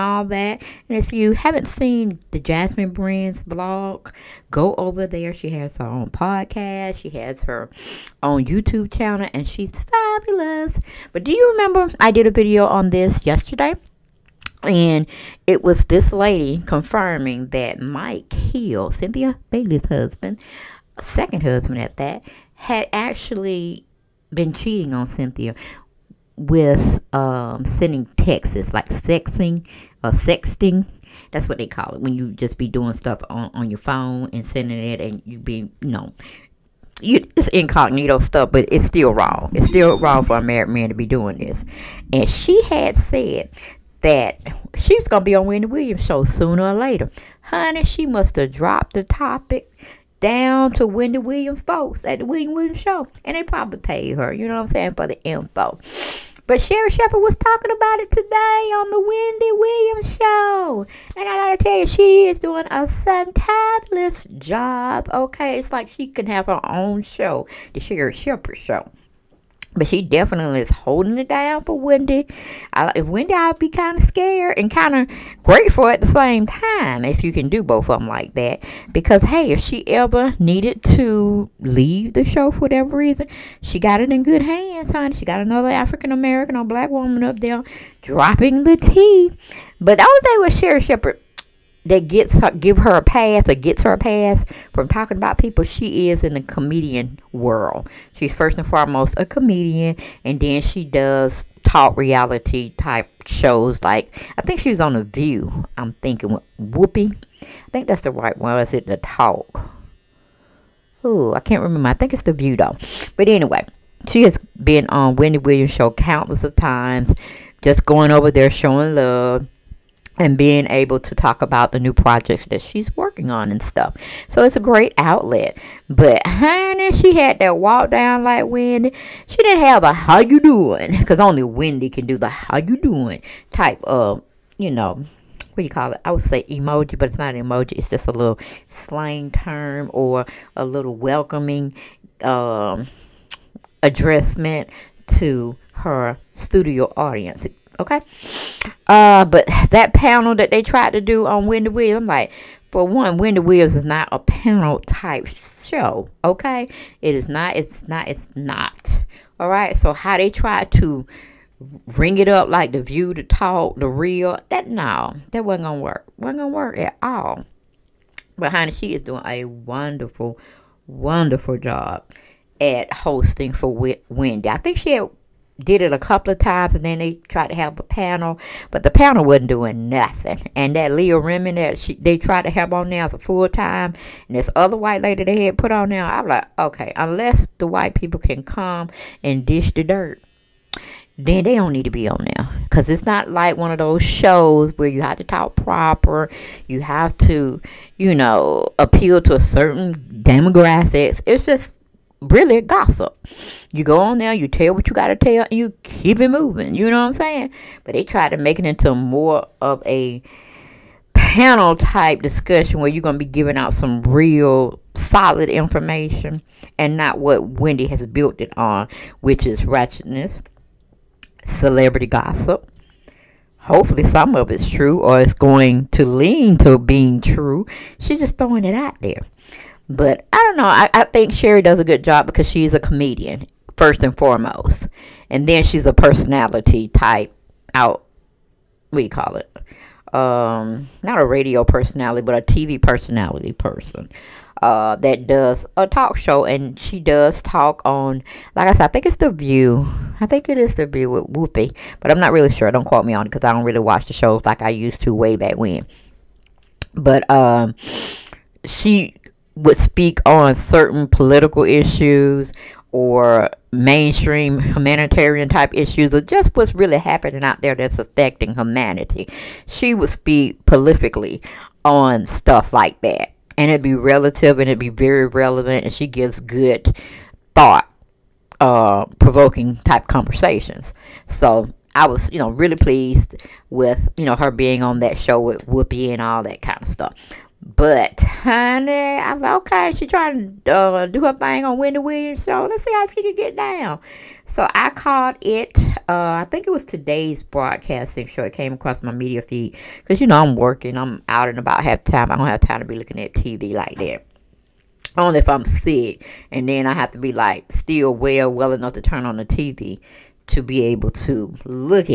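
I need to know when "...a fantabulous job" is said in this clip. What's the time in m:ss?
1:02.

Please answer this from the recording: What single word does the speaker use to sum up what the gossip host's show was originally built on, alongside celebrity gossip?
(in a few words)
Ratchetness.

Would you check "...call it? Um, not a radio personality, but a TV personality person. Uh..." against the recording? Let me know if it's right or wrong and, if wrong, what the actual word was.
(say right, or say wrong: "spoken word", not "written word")
right.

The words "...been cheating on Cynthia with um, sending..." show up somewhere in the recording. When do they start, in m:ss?
0:24.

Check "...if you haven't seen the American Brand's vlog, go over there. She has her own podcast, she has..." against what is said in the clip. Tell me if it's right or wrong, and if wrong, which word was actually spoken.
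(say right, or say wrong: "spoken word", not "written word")
wrong: "Jasmine", not "American".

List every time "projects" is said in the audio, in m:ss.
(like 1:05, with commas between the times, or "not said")
2:01.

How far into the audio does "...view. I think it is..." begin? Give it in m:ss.
4:09.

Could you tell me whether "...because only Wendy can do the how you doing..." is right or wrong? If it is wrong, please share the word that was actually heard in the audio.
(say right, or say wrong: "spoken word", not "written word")
right.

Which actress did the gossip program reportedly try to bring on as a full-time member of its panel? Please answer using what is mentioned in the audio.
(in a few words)
Leah Remini.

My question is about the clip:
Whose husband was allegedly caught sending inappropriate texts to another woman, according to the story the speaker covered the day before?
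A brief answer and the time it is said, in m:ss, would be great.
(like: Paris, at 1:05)
Cynthia Bailey, at 0:18.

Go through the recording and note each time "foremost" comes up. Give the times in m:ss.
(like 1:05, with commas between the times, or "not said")
1:38, 3:54.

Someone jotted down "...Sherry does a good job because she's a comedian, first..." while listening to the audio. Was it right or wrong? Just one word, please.
right.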